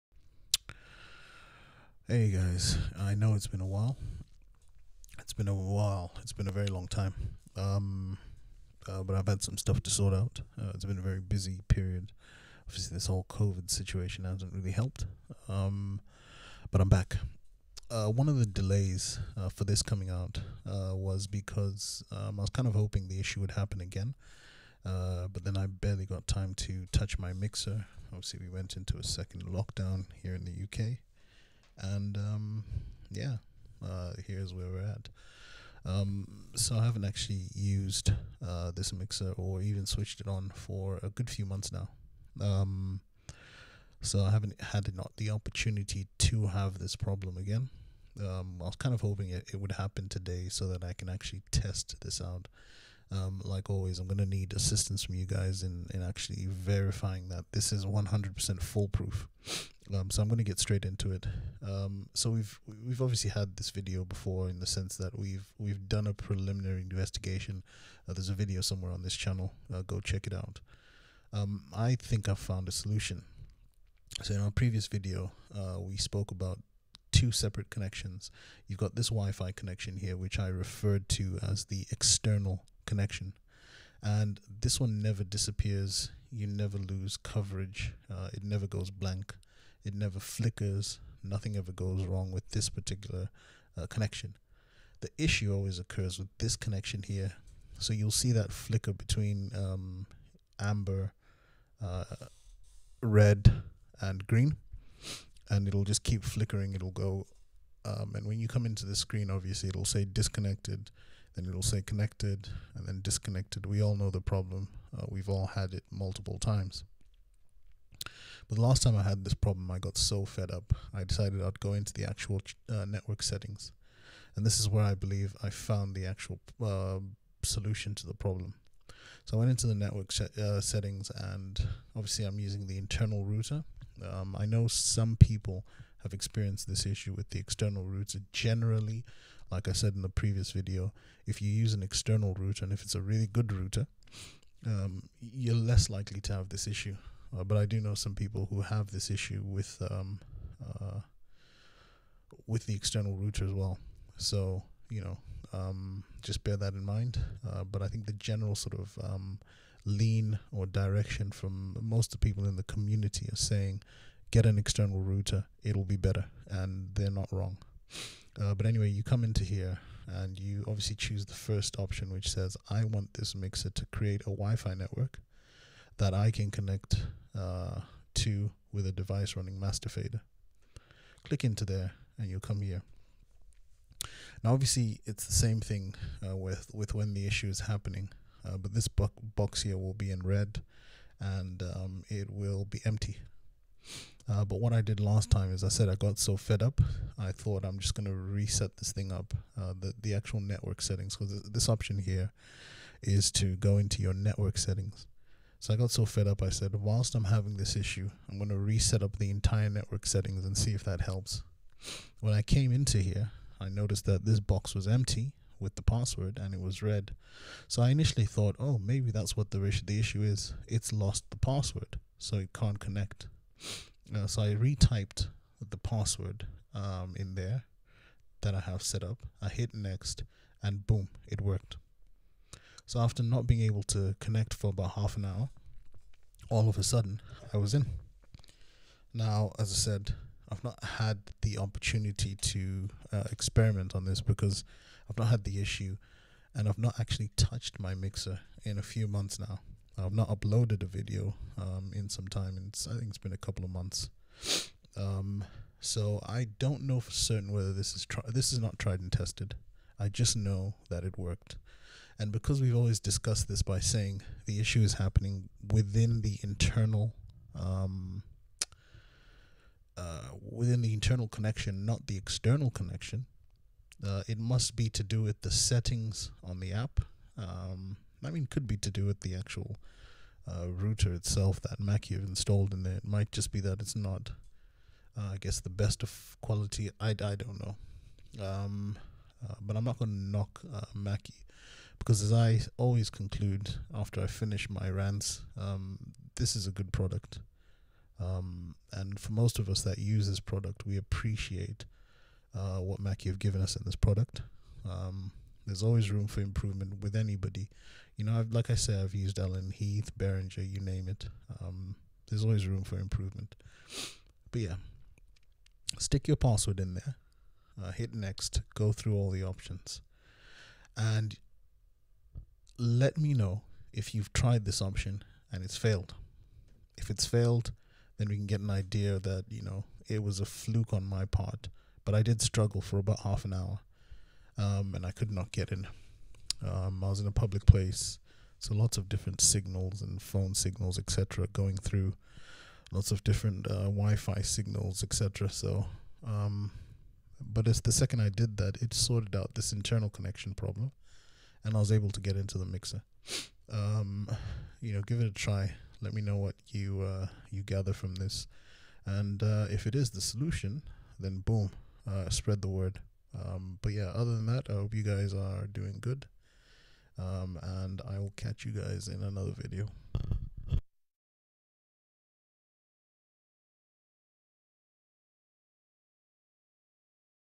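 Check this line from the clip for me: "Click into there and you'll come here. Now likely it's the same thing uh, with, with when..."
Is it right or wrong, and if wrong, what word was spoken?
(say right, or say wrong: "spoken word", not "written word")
wrong: "obviously", not "likely".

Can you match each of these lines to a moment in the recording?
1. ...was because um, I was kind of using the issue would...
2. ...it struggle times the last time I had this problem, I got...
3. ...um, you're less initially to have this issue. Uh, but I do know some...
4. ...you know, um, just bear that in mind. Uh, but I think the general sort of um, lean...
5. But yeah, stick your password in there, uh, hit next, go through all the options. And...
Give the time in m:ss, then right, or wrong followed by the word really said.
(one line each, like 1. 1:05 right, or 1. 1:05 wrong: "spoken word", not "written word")
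1. 0:20 wrong: "hoping", not "using"
2. 1:55 wrong: "multiple", not "struggle"
3. 2:24 wrong: "likely", not "initially"
4. 2:34 right
5. 5:14 right.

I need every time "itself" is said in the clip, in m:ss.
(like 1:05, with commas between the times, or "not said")
4:41.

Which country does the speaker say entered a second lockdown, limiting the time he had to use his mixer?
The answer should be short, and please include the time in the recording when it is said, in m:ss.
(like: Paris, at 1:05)
UK, at 0:30.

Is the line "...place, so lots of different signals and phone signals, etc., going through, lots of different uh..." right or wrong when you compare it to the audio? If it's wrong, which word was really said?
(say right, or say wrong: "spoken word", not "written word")
right.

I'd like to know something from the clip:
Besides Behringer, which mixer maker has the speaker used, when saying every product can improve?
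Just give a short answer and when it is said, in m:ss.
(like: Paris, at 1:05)
Allen Heath, at 5:09.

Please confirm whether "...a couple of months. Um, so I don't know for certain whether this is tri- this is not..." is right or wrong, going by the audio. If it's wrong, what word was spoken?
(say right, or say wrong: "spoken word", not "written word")
right.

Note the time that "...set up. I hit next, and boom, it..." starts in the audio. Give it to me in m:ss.
3:48.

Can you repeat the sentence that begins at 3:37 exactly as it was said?
So I initially thought, oh, maybe that's what the, the issue is.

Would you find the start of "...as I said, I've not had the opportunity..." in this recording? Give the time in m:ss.
3:59.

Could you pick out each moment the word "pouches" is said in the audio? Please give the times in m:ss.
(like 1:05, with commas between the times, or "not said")
not said.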